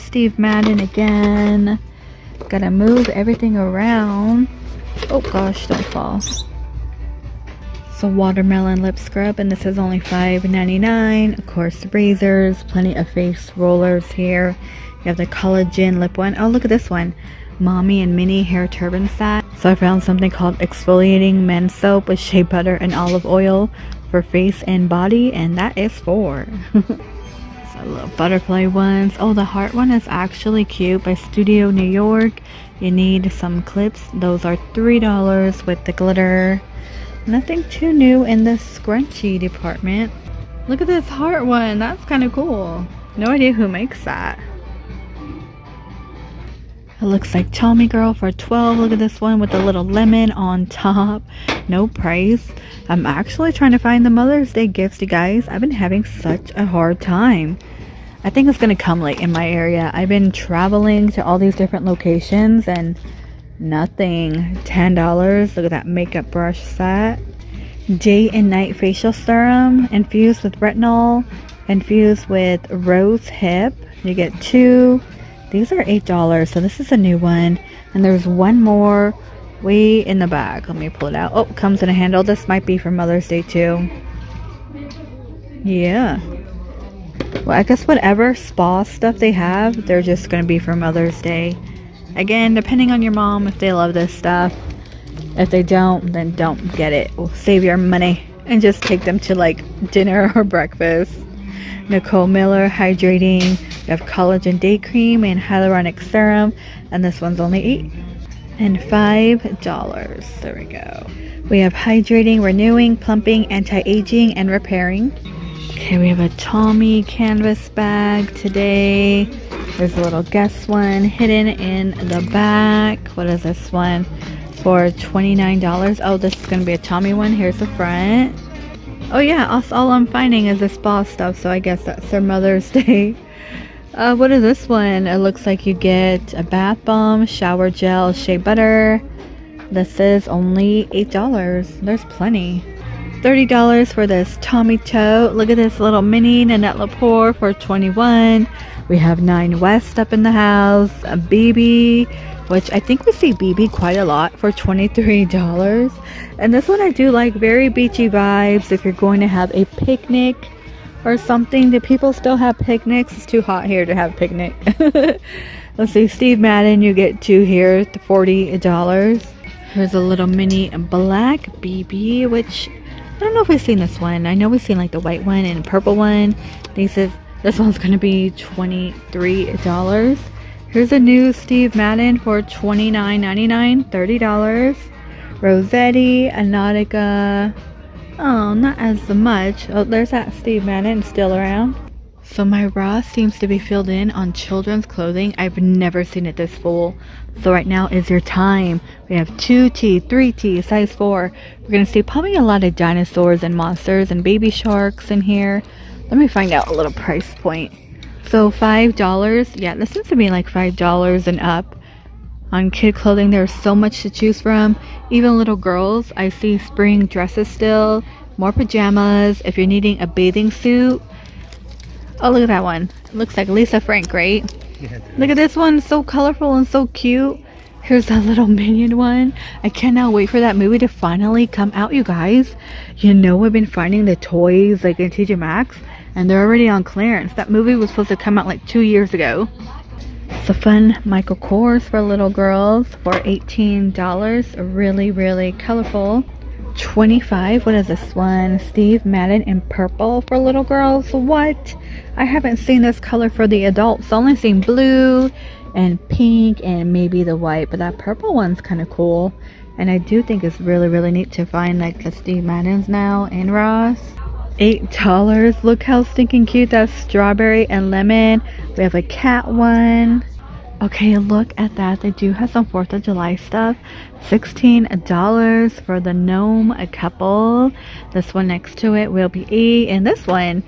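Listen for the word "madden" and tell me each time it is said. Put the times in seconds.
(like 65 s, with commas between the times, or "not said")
0 s, 166 s, 181 s, 190 s, 249 s, 262 s.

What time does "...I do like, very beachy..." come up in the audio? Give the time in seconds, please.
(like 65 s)
156 s.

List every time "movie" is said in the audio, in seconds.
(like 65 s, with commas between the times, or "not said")
230 s, 237 s.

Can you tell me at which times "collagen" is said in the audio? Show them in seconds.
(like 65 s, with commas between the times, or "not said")
15 s, 104 s.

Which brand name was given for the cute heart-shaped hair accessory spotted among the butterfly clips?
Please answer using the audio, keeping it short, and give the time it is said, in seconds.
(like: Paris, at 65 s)
Studio New York, at 31 s.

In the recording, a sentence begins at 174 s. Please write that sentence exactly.
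I know we've seen like the white one and purple one.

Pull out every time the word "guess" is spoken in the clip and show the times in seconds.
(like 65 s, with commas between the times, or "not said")
87 s, 120 s, 131 s.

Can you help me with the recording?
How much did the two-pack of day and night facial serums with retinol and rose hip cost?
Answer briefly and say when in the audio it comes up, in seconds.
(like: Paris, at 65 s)
$8, at 75 s.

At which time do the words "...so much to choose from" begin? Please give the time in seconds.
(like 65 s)
213 s.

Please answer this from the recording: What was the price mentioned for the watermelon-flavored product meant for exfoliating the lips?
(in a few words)
$5.99.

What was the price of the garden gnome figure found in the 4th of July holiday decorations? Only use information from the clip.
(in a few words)
$16.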